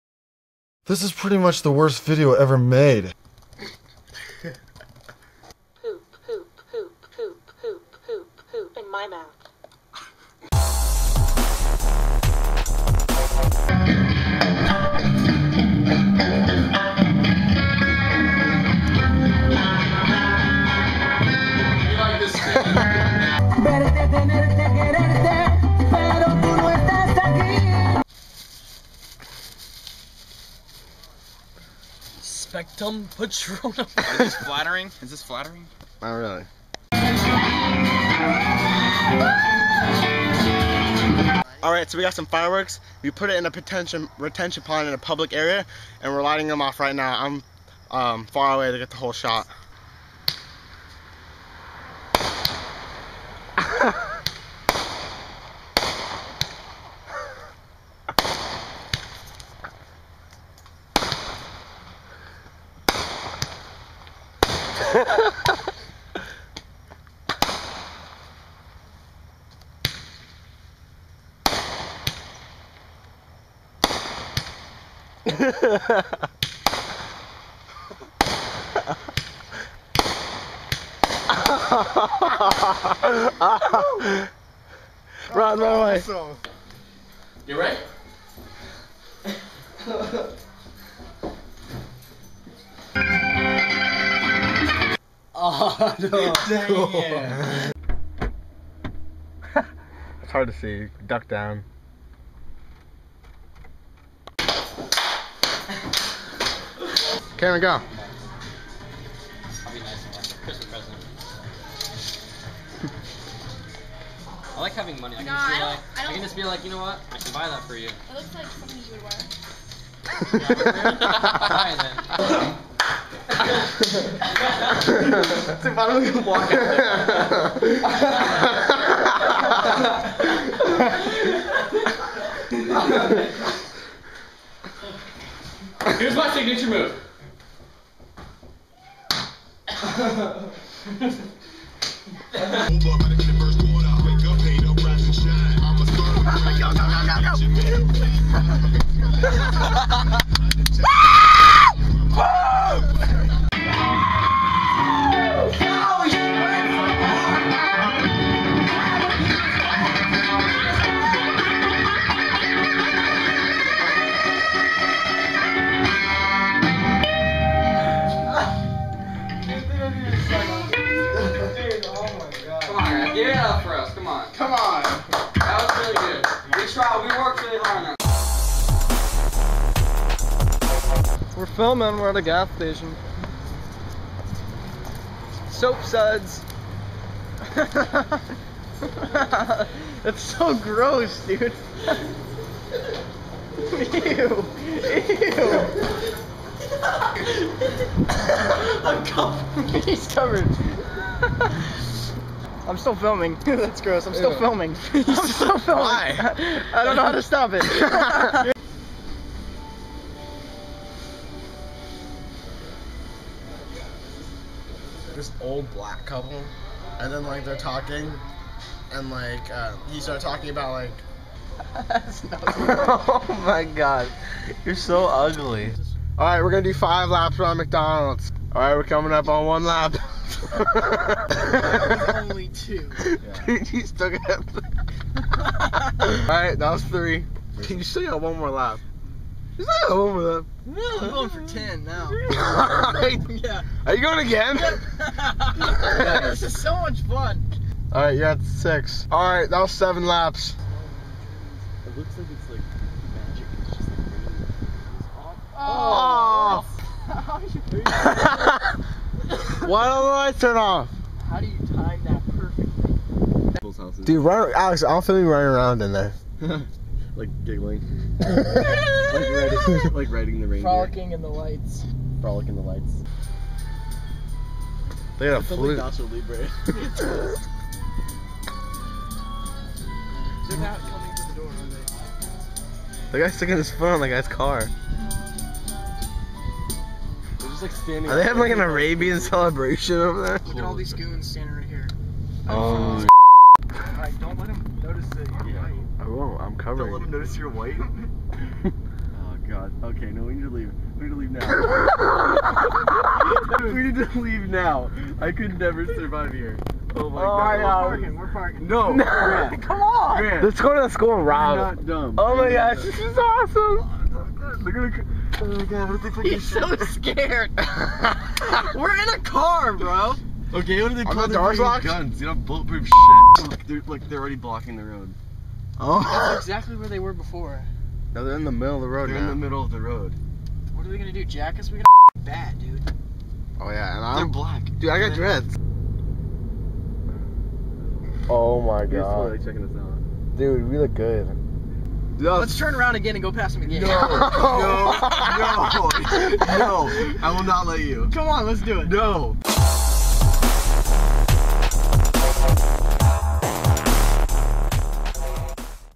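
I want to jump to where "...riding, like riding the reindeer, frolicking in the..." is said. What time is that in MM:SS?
04:29.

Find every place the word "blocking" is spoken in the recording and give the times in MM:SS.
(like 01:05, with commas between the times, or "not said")
05:24.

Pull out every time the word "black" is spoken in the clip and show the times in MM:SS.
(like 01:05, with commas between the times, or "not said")
03:35, 05:34.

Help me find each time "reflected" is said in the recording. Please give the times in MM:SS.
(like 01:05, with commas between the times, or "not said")
not said.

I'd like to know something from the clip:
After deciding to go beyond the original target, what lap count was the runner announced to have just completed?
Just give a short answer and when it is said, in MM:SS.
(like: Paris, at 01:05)
7, at 04:09.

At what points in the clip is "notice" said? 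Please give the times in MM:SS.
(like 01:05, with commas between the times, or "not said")
04:57.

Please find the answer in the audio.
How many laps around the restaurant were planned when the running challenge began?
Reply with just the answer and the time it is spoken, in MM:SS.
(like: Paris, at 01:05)
5, at 03:46.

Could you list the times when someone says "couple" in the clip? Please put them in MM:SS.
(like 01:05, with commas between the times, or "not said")
03:36.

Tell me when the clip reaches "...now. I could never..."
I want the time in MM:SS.
05:04.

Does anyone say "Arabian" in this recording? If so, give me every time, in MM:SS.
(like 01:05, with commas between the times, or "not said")
04:48.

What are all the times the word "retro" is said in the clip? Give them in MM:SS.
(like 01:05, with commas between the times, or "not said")
not said.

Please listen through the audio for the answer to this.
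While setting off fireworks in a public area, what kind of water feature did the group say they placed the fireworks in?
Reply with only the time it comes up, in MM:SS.
00:44.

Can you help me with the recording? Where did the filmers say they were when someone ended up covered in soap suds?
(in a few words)
gas station.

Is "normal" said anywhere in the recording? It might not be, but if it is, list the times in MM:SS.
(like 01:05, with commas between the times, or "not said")
not said.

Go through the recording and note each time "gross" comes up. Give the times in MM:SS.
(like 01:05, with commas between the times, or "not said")
03:10, 03:23.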